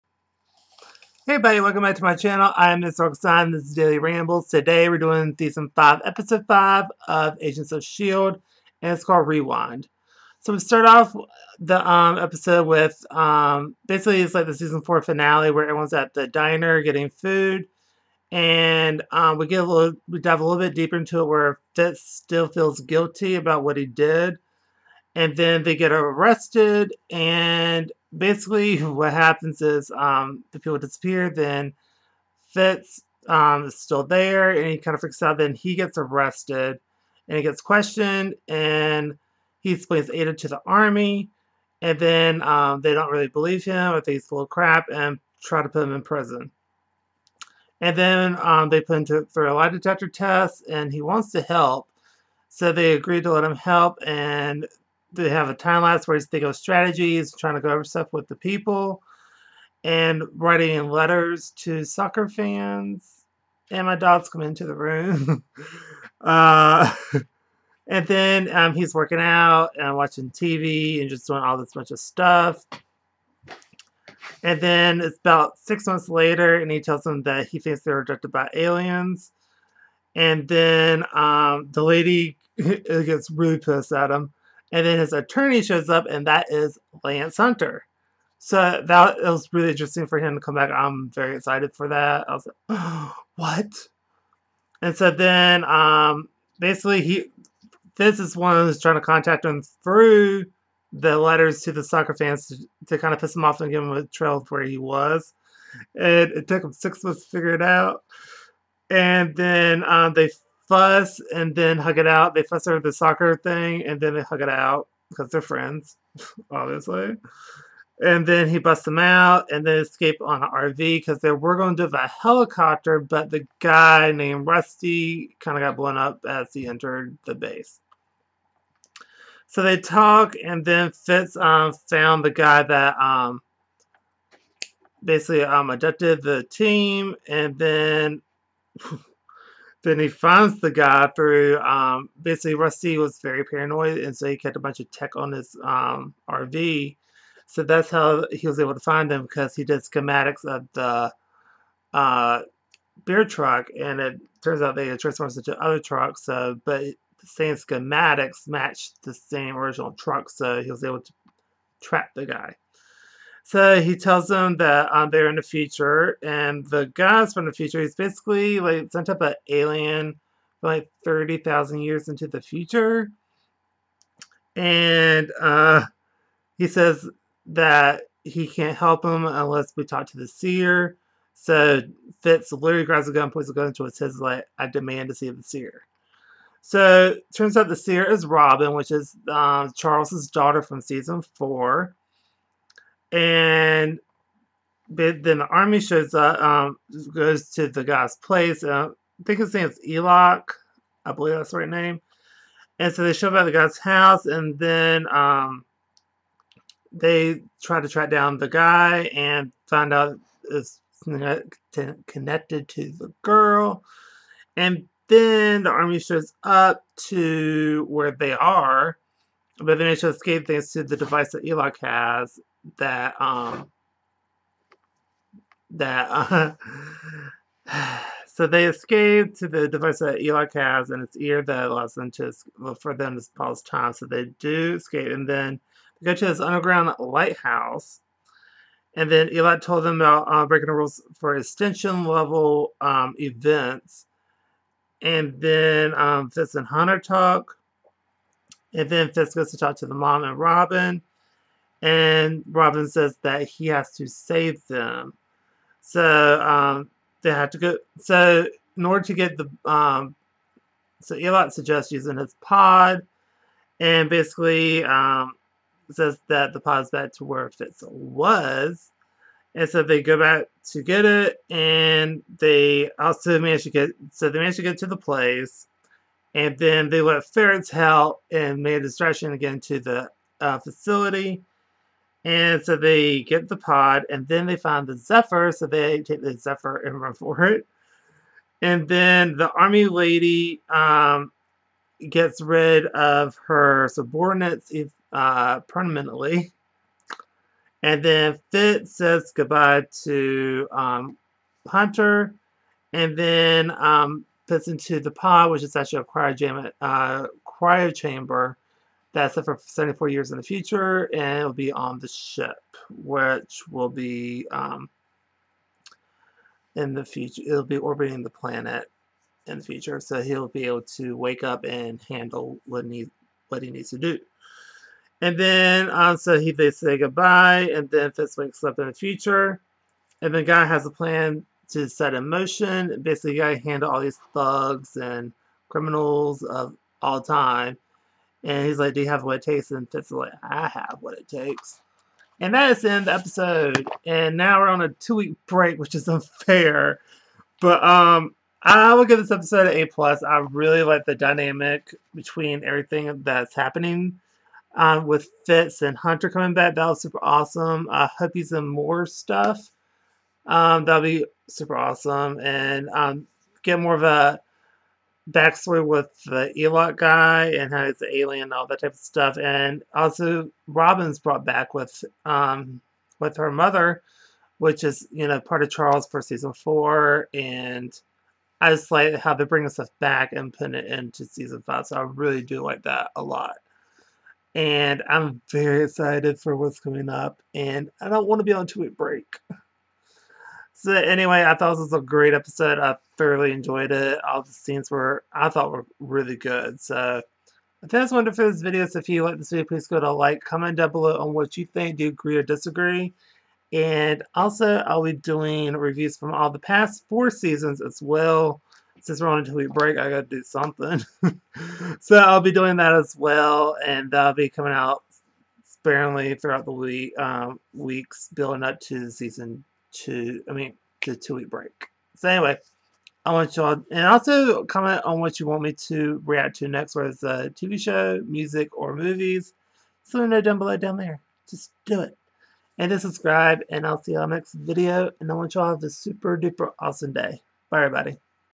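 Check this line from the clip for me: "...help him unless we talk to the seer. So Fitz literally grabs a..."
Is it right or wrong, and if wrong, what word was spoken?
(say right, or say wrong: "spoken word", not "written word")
right.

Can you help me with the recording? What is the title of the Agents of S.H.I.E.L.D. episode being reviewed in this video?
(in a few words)
Rewind.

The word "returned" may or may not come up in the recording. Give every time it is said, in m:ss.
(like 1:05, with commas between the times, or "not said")
not said.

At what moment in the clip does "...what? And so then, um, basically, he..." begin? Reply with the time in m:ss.
1:33.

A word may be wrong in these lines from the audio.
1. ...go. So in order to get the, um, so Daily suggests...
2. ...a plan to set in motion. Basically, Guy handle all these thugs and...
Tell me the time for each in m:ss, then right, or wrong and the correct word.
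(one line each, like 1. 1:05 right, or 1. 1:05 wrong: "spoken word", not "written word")
1. 4:17 wrong: "Elot", not "Daily"
2. 5:30 right.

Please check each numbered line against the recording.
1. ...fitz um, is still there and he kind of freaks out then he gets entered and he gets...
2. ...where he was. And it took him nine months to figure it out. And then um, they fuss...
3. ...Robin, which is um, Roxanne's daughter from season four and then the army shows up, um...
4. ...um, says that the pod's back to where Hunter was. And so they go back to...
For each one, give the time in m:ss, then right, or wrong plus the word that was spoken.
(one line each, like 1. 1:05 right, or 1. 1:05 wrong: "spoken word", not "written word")
1. 0:32 wrong: "arrested", not "entered"
2. 1:44 wrong: "six", not "nine"
3. 3:08 wrong: "Charles", not "Roxanne"
4. 4:24 wrong: "Fitz", not "Hunter".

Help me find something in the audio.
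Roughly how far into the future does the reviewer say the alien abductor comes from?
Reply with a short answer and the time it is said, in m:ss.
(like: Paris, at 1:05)
30,000 years, at 2:51.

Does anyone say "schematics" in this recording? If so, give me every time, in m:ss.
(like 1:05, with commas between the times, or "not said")
2:29, 2:37.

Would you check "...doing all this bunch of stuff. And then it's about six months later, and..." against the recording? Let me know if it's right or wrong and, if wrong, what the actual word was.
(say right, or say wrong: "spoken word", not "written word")
right.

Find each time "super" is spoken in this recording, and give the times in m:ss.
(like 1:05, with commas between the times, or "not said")
5:57, 6:01, 7:15.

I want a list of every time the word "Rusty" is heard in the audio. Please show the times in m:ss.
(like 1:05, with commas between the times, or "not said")
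2:04, 2:22.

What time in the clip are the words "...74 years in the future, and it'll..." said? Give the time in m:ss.
5:09.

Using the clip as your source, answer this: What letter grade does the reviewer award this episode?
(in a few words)
A plus.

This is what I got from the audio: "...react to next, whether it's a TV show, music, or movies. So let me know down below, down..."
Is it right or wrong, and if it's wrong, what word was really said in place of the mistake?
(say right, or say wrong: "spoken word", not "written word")
right.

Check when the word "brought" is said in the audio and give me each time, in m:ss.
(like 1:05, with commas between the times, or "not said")
6:11.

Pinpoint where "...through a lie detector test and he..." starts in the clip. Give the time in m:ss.
0:49.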